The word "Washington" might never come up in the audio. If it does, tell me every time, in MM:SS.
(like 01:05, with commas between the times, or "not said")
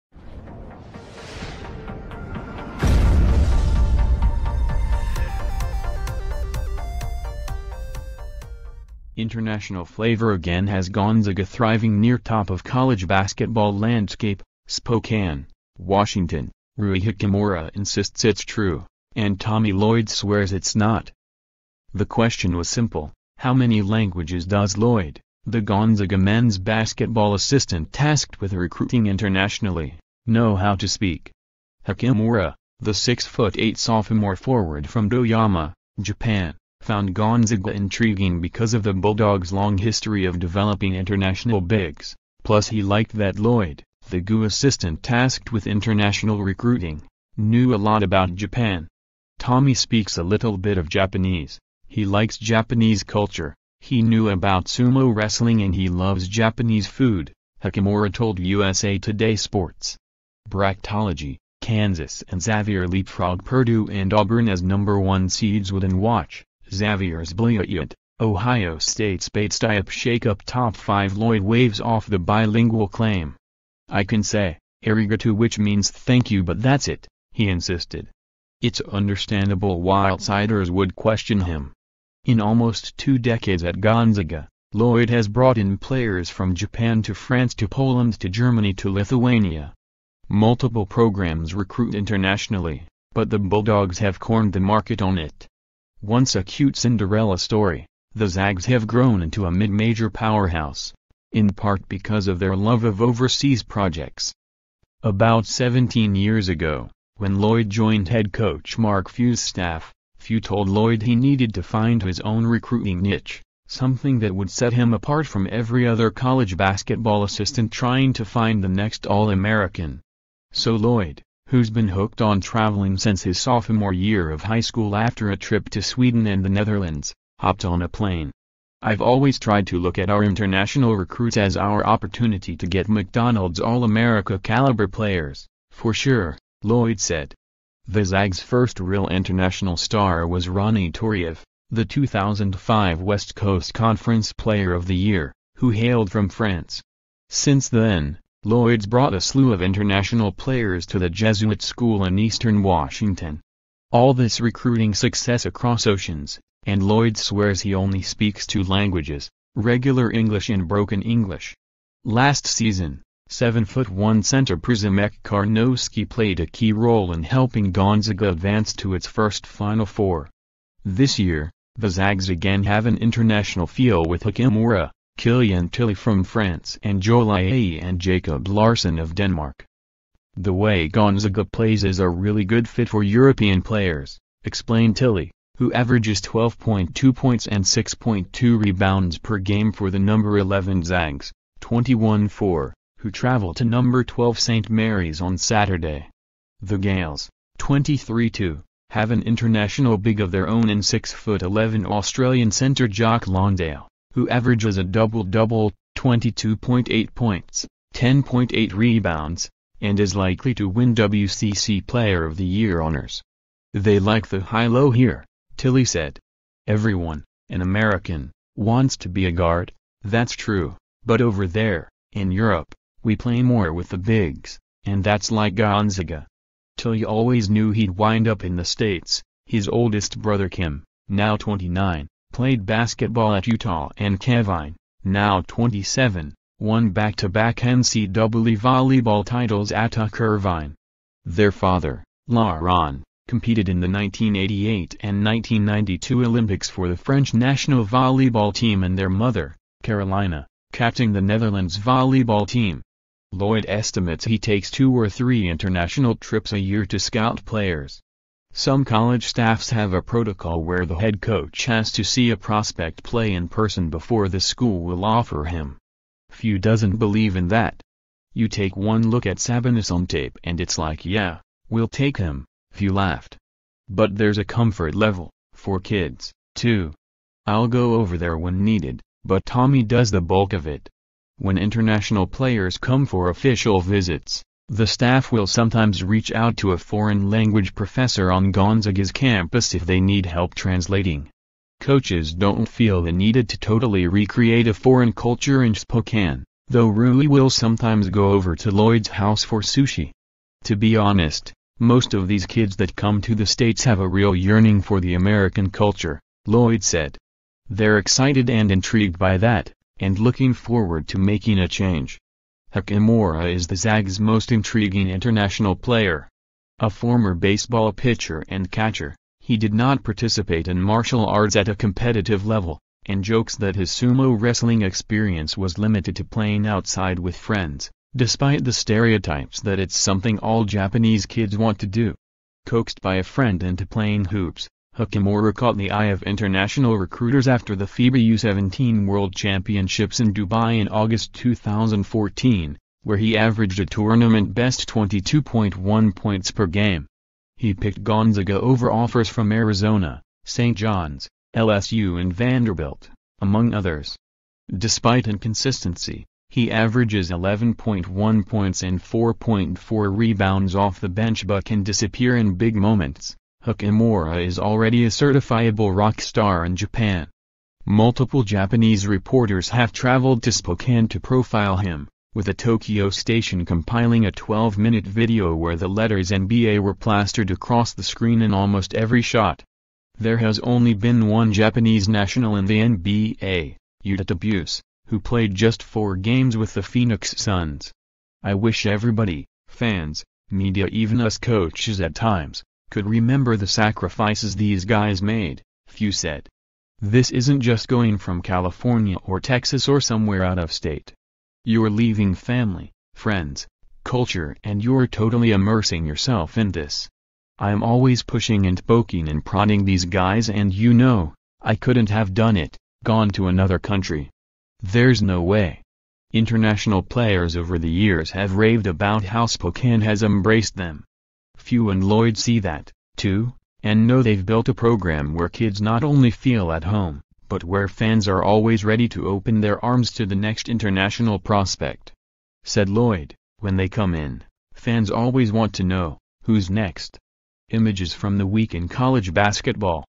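00:15, 02:32.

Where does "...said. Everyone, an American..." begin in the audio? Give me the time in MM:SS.
03:35.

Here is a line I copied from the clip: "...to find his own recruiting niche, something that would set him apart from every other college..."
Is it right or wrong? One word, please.
right.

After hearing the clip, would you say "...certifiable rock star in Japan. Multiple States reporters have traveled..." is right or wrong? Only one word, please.
wrong.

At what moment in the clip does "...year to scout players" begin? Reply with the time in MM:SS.
04:16.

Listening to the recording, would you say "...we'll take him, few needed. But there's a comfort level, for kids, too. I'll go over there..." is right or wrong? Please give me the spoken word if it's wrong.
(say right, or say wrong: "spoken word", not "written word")
wrong: "laughed", not "needed".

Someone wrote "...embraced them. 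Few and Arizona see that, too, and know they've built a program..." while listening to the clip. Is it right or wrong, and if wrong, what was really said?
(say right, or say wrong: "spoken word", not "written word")
wrong: "Lloyd", not "Arizona".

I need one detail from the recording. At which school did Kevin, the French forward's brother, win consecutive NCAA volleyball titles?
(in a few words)
Irvine.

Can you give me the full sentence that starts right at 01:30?
Multiple programs recruit internationally, but the Bulldogs have cornered the market on it.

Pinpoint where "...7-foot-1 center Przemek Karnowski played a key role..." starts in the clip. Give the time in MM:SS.
02:43.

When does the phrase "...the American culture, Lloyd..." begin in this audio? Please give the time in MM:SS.
05:05.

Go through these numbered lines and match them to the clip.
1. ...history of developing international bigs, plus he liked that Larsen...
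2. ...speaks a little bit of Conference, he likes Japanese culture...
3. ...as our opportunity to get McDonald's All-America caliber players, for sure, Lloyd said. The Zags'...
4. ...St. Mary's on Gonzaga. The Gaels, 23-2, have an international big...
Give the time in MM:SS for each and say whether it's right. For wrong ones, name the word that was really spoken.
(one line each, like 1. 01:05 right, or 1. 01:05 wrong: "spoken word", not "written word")
1. 00:39 wrong: "Lloyd", not "Larsen"
2. 00:49 wrong: "Japanese", not "Conference"
3. 02:11 right
4. 03:14 wrong: "Saturday", not "Gonzaga".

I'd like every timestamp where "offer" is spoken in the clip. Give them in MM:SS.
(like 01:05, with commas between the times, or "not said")
04:25, 05:48.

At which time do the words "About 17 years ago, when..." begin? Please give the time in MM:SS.
01:45.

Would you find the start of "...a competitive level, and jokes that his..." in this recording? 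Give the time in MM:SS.
05:21.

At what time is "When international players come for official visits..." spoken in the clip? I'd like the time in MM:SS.
04:41.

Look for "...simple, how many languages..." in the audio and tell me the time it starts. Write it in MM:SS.
00:22.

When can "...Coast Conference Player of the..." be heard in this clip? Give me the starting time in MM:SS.
02:23.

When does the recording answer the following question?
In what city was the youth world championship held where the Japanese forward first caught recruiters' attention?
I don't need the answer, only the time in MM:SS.
05:40.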